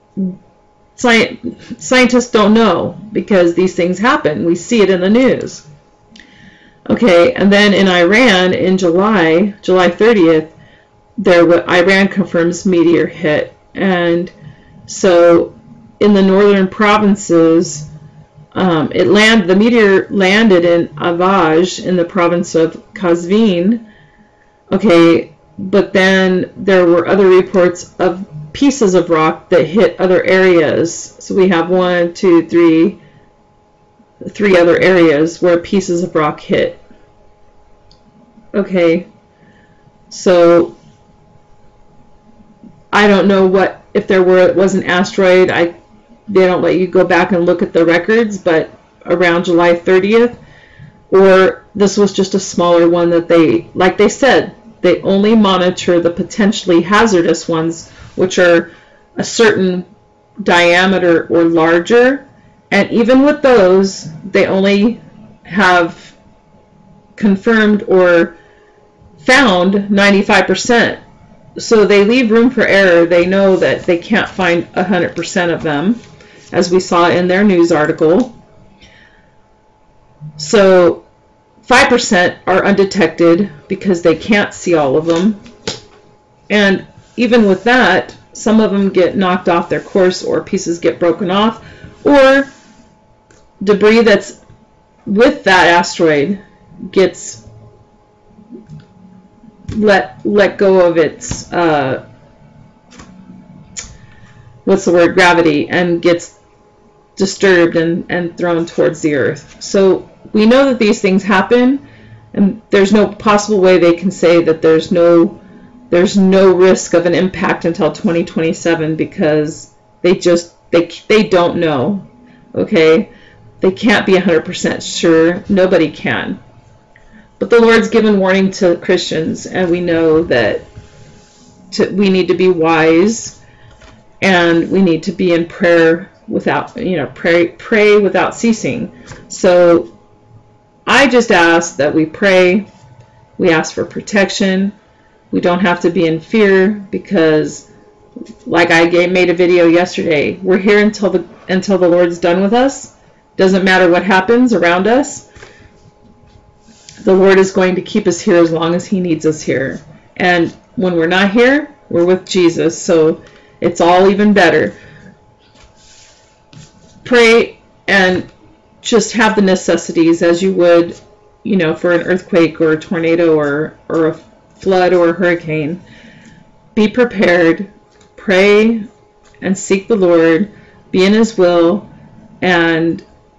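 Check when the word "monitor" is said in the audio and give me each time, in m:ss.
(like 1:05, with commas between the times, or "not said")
0:55.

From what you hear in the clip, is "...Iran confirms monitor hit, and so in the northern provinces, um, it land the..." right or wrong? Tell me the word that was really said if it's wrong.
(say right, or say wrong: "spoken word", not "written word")
wrong: "meteor", not "monitor".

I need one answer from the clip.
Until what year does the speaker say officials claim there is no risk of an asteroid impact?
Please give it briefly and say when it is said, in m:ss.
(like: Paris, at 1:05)
2027, at 1:57.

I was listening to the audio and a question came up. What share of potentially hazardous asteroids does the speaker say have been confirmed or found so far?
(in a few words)
95%.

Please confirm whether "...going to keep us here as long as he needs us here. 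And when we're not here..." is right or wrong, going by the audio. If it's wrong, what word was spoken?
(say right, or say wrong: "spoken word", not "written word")
right.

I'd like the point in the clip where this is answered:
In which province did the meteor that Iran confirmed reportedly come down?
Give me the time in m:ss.
0:22.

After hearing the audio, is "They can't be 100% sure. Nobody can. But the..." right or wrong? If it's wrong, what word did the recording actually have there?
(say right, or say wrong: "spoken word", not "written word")
right.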